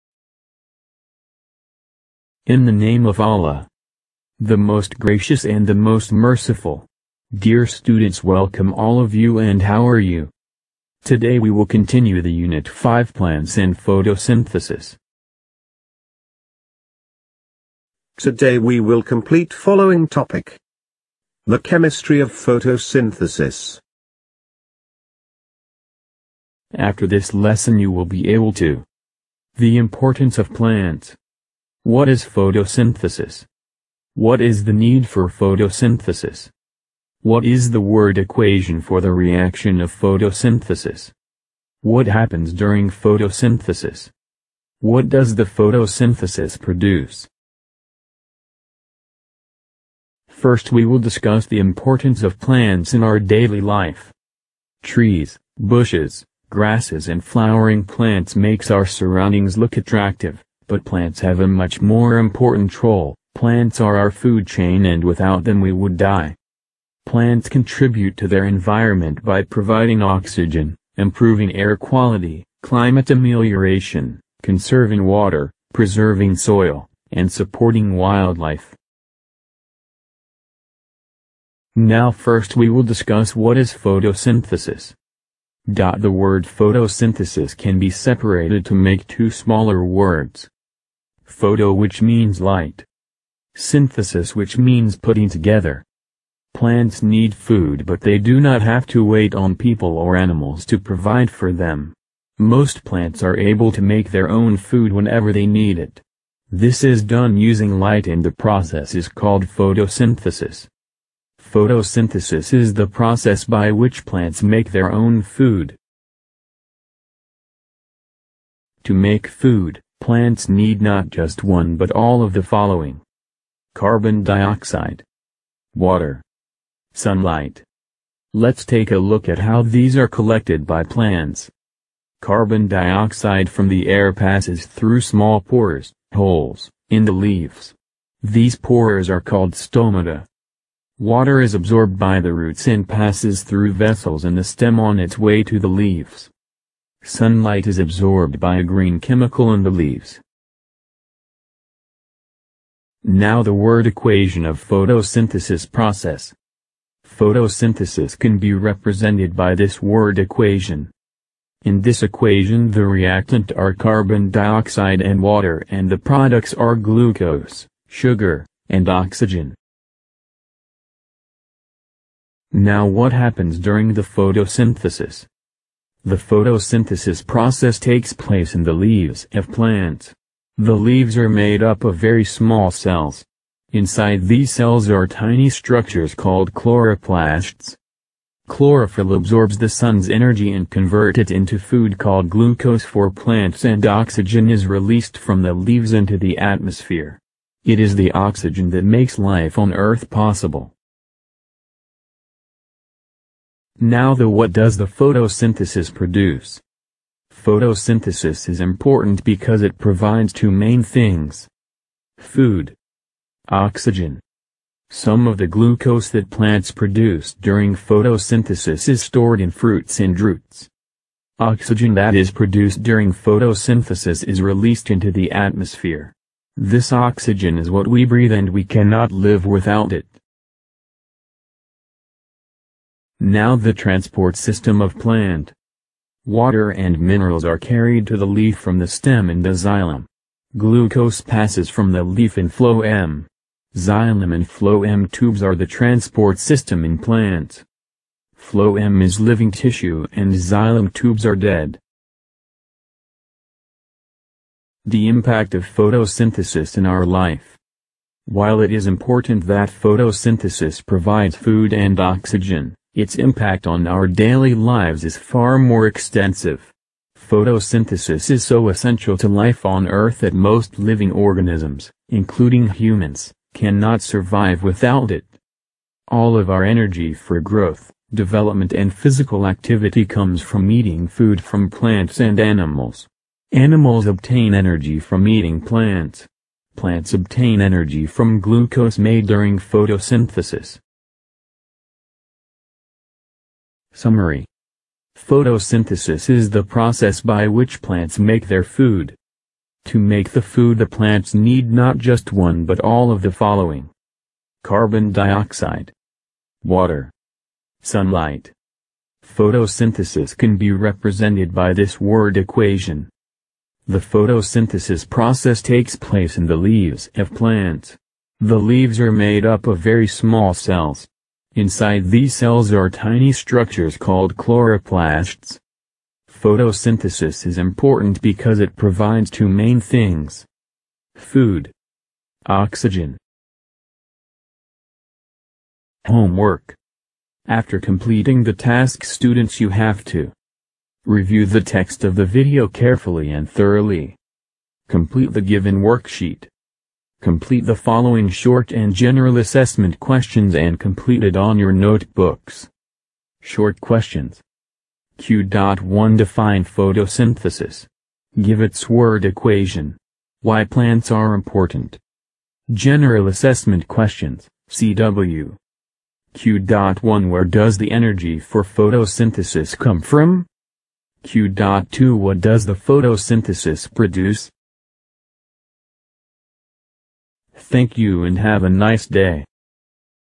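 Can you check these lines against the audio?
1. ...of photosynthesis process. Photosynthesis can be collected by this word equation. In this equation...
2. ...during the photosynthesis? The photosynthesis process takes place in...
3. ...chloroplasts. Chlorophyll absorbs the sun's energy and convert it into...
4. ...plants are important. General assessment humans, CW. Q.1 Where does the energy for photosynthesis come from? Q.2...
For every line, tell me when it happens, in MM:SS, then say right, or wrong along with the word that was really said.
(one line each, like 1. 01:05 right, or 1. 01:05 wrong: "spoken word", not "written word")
1. 02:34 wrong: "represented", not "collected"
2. 02:53 right
3. 03:06 right
4. 06:00 wrong: "questions", not "humans".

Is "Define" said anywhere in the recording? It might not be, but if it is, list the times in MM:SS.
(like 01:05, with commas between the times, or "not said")
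05:56.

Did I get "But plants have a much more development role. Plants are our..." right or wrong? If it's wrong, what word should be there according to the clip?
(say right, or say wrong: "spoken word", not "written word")
wrong: "important", not "development".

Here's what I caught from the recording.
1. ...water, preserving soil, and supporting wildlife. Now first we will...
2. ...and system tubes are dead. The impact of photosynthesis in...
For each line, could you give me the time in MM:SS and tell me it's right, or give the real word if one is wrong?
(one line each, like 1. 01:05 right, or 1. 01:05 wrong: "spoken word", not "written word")
1. 01:15 right
2. 04:10 wrong: "xylem", not "system".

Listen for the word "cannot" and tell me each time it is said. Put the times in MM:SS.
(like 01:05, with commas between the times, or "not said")
03:48, 04:33.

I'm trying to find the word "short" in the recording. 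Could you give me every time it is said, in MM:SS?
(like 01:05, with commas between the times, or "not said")
05:48, 05:53.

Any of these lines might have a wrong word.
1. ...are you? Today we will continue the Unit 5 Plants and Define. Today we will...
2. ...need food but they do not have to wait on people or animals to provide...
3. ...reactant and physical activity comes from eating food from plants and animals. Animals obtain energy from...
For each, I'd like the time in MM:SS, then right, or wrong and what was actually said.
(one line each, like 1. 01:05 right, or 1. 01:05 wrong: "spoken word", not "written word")
1. 00:09 wrong: "Photosynthesis", not "Define"
2. 01:37 right
3. 04:38 wrong: "development", not "reactant".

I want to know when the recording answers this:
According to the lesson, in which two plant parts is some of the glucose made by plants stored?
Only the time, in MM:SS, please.
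03:39.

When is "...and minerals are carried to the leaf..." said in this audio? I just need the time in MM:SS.
03:56.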